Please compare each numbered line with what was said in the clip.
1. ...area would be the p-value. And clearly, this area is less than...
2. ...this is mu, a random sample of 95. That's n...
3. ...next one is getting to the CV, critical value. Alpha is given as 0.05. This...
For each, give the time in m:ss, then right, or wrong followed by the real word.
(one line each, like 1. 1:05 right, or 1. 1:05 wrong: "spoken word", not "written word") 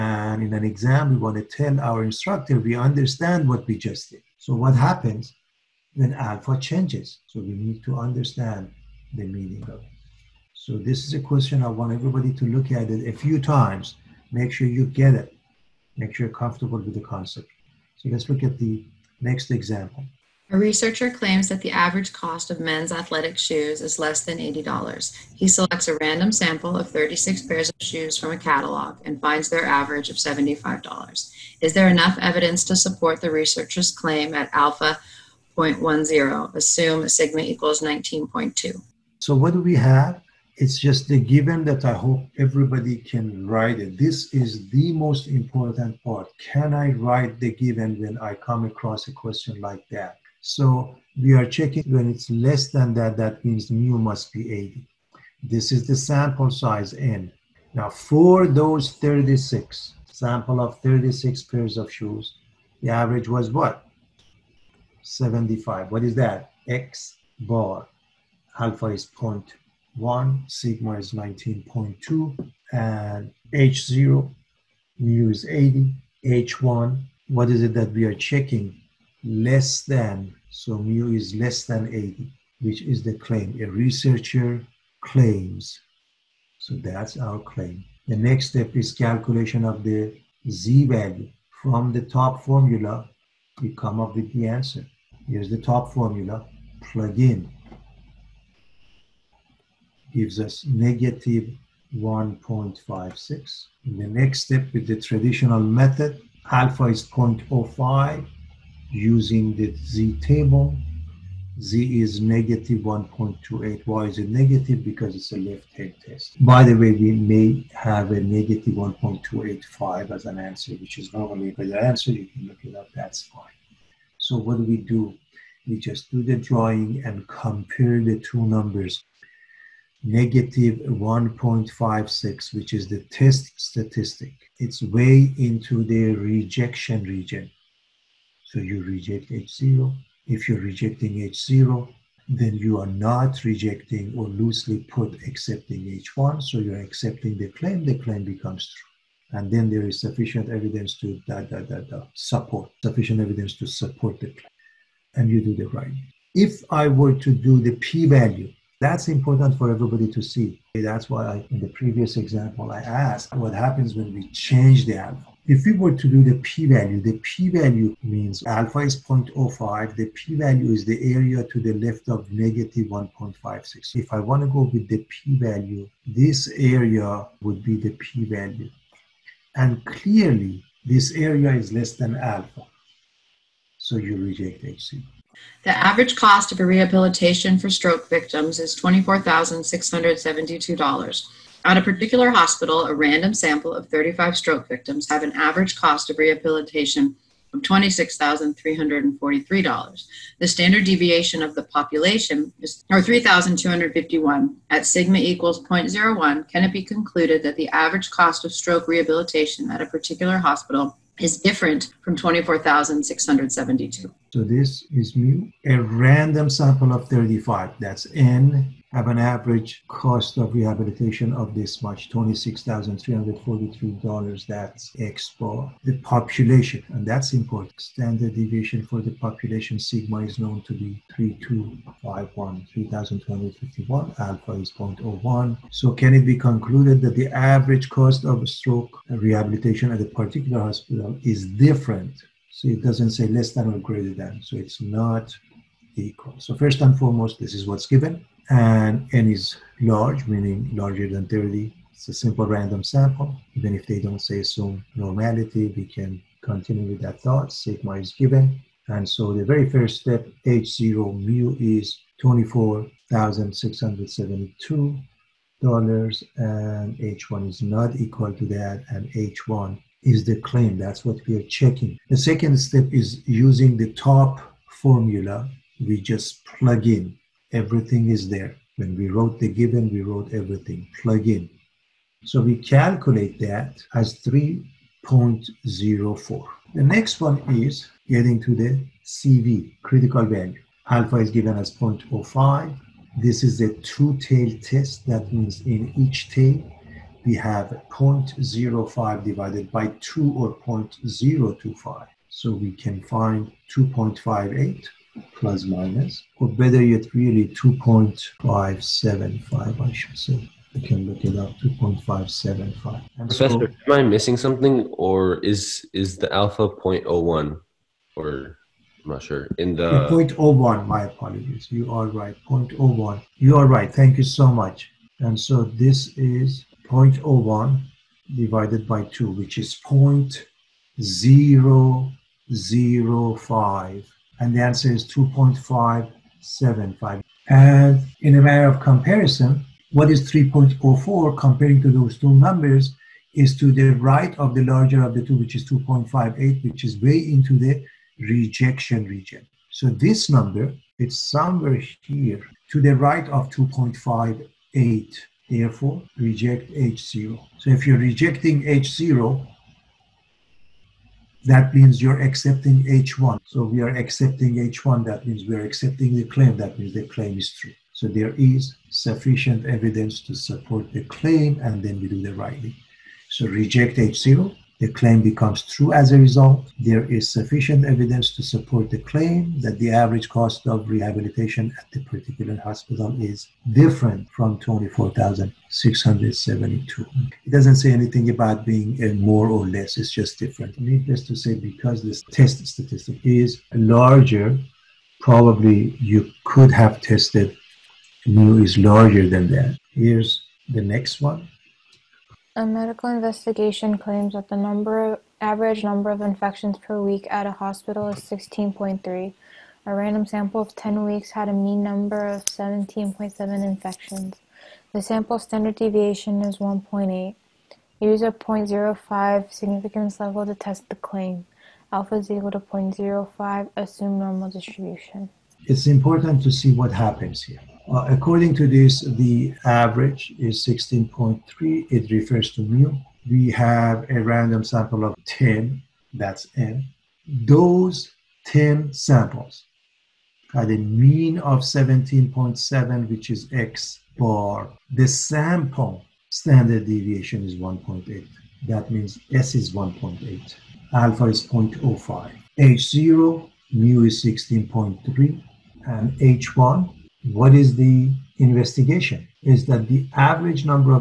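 1. 2:56 right
2. 3:34 wrong: "35", not "95"
3. 4:46 right.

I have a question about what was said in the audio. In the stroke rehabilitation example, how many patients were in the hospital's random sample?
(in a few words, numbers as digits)
35.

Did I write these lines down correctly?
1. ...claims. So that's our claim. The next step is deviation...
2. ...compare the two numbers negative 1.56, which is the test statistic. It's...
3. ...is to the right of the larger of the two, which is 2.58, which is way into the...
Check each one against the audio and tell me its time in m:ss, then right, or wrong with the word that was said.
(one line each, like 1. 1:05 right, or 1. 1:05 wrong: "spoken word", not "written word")
1. 1:25 wrong: "calculation", not "deviation"
2. 2:07 right
3. 5:43 right.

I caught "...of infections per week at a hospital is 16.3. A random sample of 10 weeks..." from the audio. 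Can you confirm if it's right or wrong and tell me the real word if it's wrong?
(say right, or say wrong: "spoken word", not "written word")
right.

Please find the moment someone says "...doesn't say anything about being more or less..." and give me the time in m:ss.
6:27.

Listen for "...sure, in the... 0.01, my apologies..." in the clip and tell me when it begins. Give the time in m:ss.
5:19.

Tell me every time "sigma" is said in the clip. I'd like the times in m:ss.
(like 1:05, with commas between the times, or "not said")
0:37, 1:10, 3:24, 3:49, 4:17.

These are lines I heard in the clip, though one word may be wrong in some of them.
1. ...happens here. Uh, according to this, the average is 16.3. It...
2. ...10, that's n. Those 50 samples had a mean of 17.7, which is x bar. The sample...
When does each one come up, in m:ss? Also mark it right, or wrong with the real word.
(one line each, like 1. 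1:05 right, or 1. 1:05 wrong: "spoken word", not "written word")
1. 7:06 right
2. 7:15 wrong: "10", not "50".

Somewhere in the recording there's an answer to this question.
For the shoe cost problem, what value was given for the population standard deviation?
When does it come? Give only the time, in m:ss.
0:37.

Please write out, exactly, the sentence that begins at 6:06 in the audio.
That means the claim is true.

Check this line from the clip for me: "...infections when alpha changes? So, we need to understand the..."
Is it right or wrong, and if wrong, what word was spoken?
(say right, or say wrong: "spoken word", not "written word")
wrong: "happens", not "infections".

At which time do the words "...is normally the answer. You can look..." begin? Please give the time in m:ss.
2:00.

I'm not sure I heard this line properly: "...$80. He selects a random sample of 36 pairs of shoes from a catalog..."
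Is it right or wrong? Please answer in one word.
right.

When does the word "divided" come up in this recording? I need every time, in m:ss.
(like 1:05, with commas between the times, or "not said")
4:59, 5:28.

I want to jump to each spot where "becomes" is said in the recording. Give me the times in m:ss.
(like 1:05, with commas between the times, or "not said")
2:28, 6:15.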